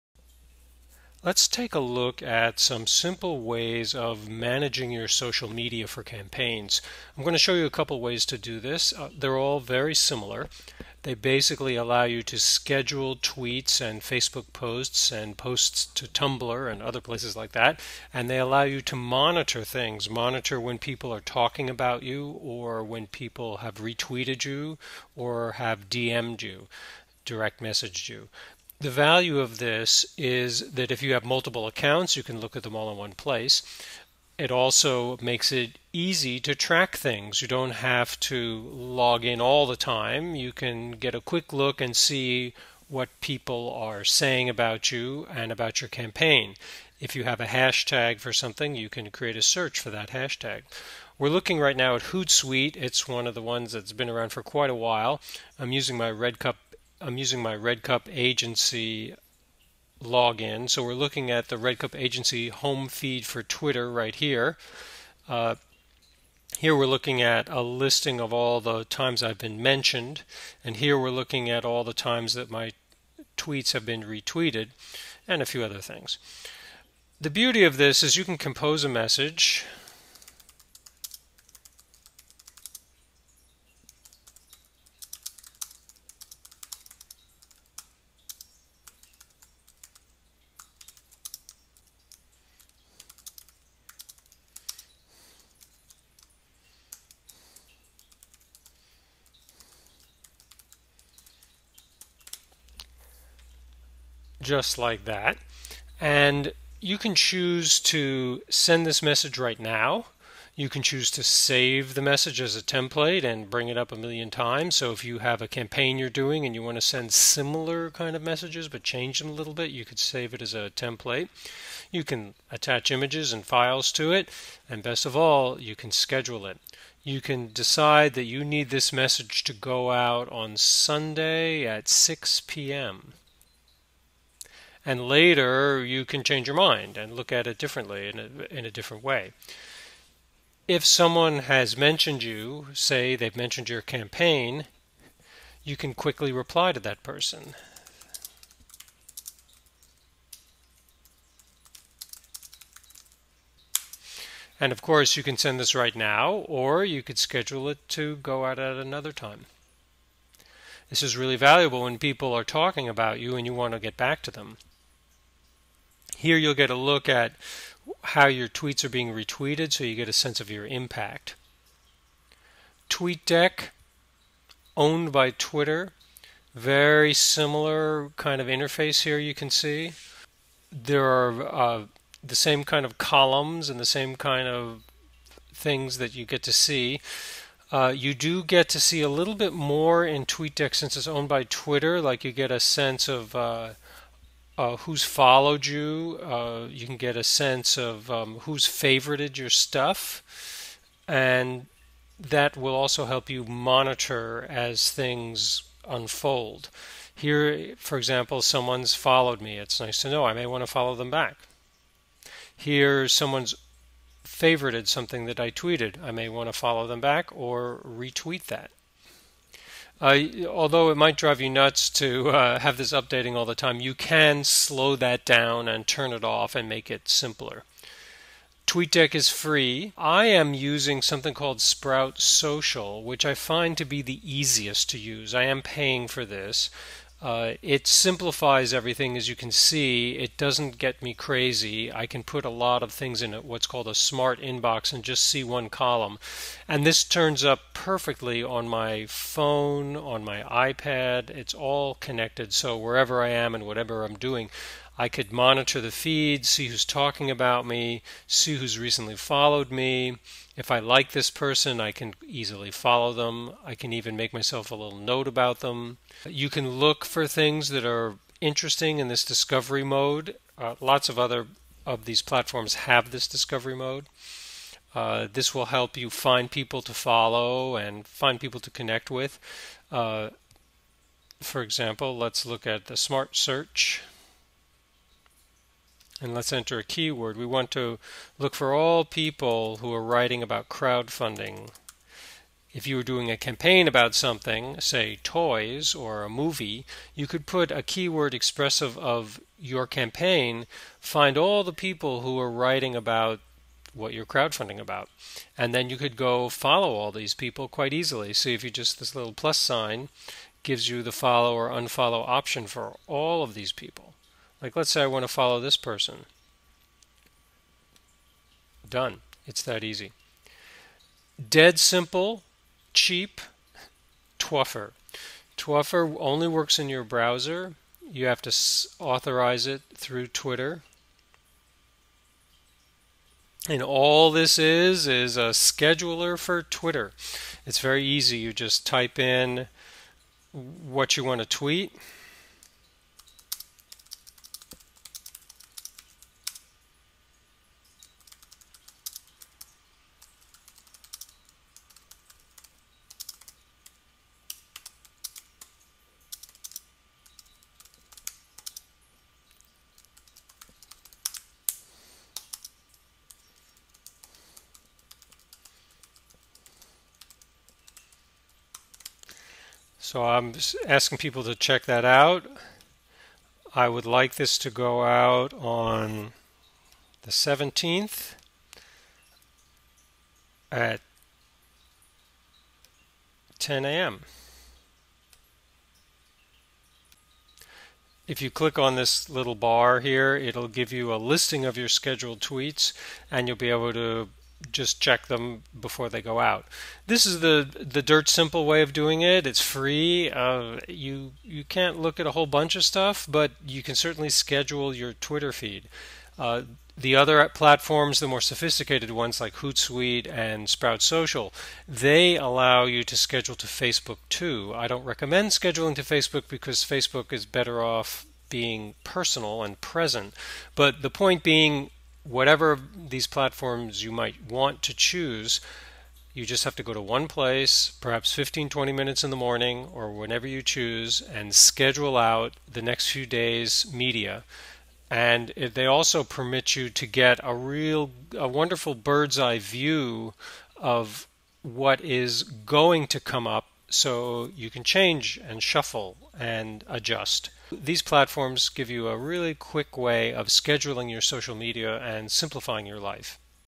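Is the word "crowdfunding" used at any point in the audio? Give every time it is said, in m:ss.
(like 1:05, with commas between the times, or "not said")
4:50, 5:04.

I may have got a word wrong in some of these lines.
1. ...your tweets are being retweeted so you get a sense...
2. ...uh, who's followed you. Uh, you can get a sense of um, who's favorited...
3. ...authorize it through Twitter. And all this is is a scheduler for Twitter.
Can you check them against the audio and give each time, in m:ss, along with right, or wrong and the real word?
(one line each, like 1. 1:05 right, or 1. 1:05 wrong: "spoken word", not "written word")
1. 2:48 right
2. 3:14 right
3. 5:28 right.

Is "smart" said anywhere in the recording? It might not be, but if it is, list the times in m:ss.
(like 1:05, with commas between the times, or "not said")
4:03, 4:42.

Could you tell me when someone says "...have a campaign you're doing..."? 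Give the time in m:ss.
1:55.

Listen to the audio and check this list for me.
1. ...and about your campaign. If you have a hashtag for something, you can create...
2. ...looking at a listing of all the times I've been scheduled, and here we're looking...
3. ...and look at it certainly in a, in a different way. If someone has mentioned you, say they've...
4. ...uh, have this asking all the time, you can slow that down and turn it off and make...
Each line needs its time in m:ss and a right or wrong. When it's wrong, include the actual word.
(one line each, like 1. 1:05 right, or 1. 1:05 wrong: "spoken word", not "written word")
1. 0:45 right
2. 1:06 wrong: "mentioned", not "scheduled"
3. 2:16 wrong: "differently", not "certainly"
4. 3:42 wrong: "updating", not "asking".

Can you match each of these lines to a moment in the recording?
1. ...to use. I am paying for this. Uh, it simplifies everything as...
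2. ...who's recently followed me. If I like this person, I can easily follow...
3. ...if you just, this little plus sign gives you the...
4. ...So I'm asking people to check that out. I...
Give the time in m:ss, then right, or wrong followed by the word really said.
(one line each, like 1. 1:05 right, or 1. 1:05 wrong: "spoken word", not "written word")
1. 3:54 right
2. 4:18 right
3. 5:08 right
4. 6:10 right.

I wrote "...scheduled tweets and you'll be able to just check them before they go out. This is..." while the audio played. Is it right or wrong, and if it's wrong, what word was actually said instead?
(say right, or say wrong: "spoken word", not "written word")
right.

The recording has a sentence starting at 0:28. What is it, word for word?
The value of this is that if you have multiple accounts, you can look at them all in one place.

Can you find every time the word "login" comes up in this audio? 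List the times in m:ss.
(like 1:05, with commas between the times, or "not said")
1:00.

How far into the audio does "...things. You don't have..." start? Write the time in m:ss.
0:36.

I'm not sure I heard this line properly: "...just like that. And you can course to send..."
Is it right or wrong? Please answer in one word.
wrong.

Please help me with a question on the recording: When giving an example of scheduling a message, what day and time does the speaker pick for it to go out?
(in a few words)
Sunday at 6 p.m.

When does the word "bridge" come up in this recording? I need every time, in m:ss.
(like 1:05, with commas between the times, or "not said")
not said.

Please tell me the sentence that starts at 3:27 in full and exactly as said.
Here, for example, someone's followed me.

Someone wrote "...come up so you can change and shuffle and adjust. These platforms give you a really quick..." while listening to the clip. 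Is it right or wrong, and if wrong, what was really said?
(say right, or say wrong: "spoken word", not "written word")
right.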